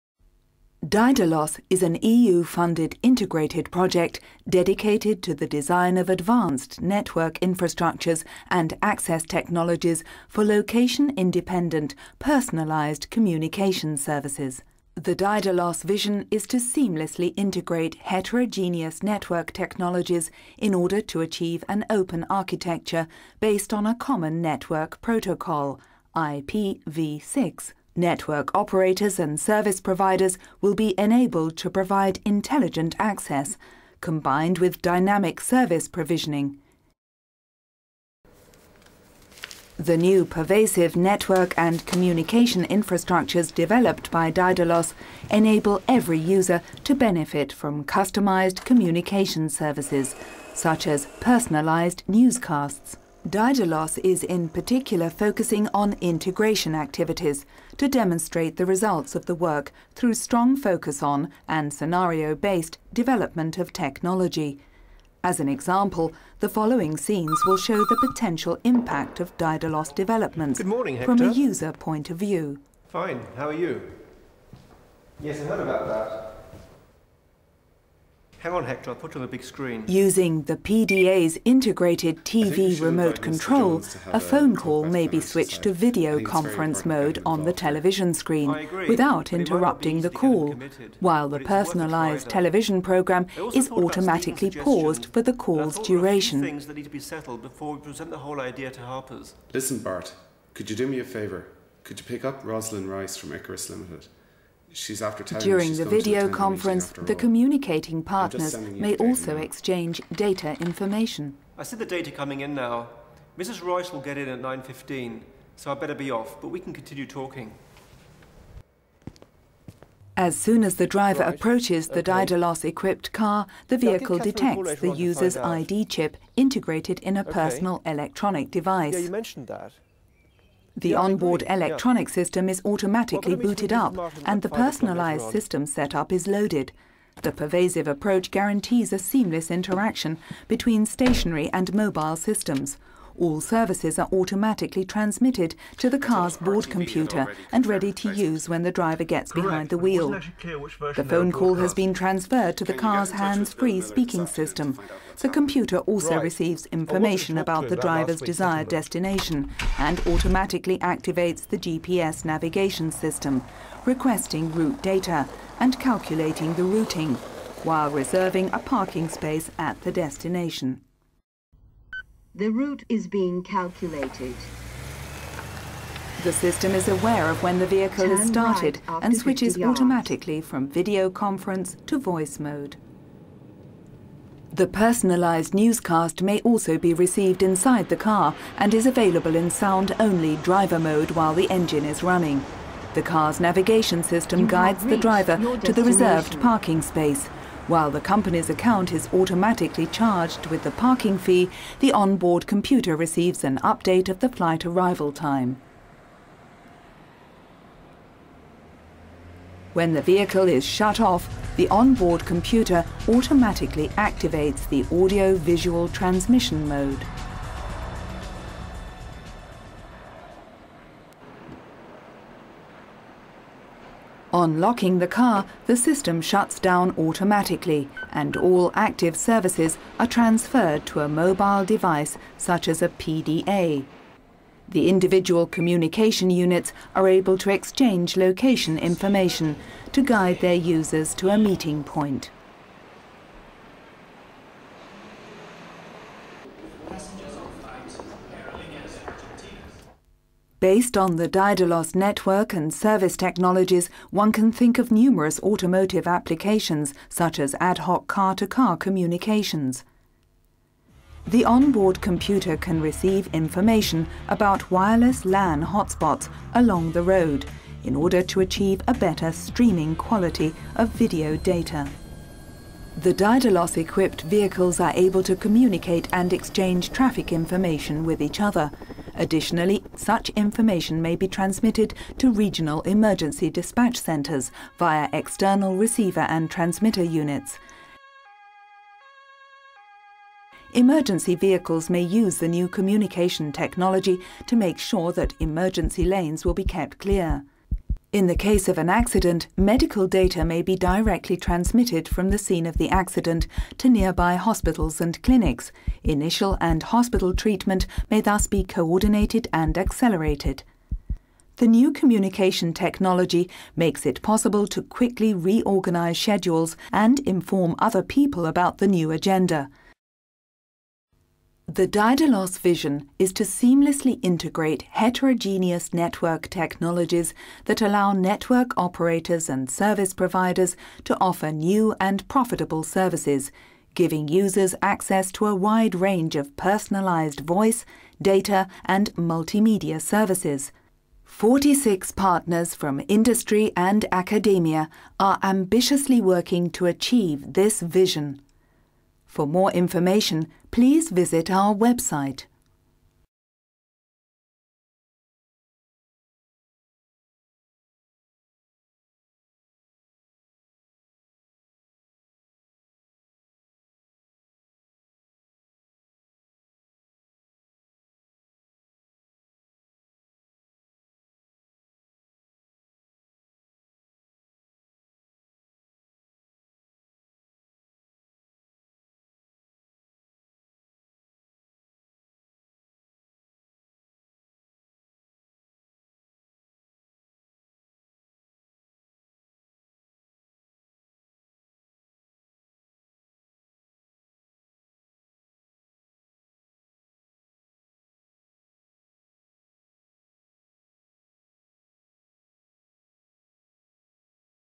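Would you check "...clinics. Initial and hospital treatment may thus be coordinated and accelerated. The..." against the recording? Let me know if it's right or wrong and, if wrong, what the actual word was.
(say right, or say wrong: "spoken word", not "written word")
right.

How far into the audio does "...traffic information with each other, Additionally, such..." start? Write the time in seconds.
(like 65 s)
276 s.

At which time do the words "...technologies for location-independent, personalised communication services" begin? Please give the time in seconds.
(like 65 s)
9 s.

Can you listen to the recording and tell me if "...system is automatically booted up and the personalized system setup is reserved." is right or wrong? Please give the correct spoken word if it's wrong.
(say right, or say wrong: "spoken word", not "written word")
wrong: "loaded", not "reserved".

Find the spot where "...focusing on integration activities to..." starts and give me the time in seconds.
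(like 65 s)
55 s.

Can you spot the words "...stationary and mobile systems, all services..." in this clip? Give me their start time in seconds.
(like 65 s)
140 s.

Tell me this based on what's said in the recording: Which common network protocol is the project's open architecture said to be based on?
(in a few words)
IPv6.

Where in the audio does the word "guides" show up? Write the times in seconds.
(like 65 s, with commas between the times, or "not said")
194 s, 240 s.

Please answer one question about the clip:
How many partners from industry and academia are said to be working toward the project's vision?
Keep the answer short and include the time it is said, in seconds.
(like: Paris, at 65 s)
46, at 341 s.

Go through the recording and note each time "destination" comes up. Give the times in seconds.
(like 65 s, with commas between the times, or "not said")
158 s, 169 s.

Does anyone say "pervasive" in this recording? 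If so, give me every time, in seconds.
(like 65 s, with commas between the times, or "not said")
40 s, 137 s.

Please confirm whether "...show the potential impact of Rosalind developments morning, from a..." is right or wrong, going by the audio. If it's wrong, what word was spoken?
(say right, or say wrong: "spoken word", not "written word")
wrong: "Daidalos", not "Rosalind".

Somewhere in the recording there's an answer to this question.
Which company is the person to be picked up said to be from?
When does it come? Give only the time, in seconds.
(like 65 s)
103 s.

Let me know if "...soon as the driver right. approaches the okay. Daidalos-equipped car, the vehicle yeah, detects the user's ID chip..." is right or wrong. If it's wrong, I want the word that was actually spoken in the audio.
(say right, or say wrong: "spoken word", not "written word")
right.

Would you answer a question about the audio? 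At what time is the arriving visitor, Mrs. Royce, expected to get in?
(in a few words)
9.15.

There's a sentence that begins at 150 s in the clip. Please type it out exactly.
The phone call has been transferred to the car's hands-free speaking system.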